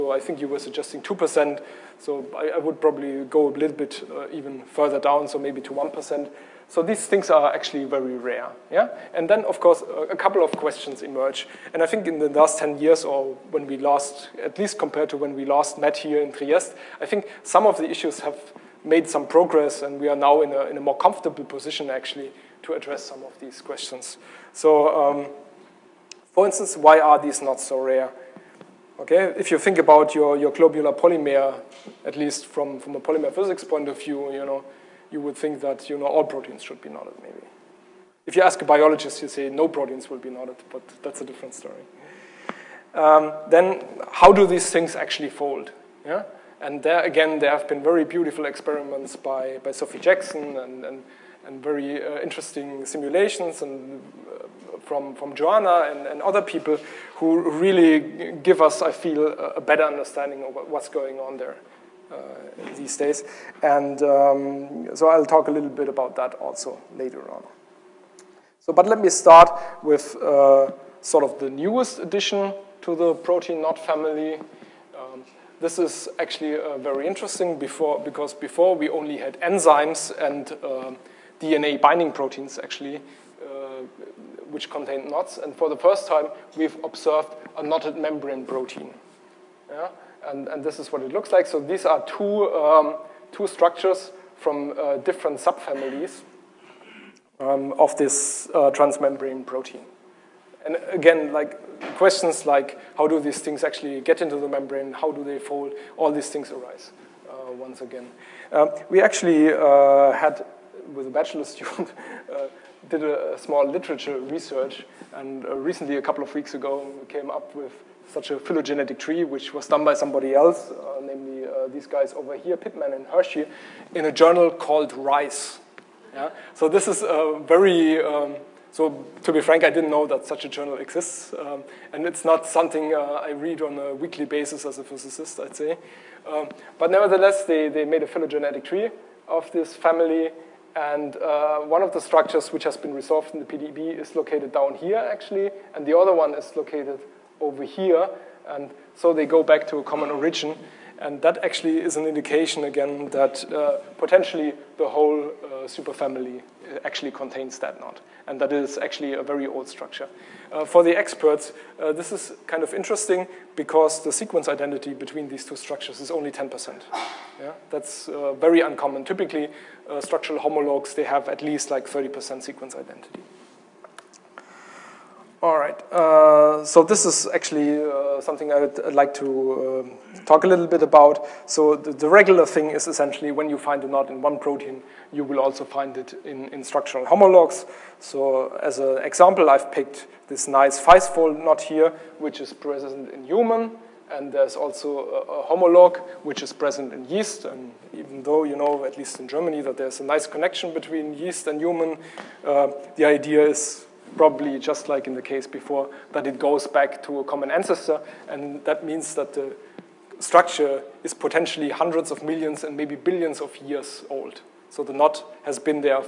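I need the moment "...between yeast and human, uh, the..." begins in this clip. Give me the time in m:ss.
3:20.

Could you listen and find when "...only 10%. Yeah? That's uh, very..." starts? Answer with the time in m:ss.
2:46.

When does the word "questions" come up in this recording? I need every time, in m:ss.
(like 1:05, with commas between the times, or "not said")
0:10, 0:23, 1:41.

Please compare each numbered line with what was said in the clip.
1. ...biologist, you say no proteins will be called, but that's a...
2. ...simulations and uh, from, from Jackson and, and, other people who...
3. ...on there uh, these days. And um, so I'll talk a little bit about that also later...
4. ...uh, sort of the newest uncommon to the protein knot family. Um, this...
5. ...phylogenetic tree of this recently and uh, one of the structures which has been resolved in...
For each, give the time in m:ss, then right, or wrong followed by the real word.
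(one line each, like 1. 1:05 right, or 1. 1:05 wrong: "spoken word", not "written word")
1. 0:38 wrong: "knotted", not "called"
2. 0:52 wrong: "Joanna", not "Jackson"
3. 1:01 right
4. 1:10 wrong: "addition", not "uncommon"
5. 2:18 wrong: "family", not "recently".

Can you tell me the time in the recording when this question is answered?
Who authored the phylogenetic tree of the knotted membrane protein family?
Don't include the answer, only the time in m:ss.
2:04.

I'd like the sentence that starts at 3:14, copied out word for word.
And there's also a, a homolog, which is present in yeast.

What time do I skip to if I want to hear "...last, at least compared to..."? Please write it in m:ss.
0:13.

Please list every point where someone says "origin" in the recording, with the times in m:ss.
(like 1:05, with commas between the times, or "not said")
2:30.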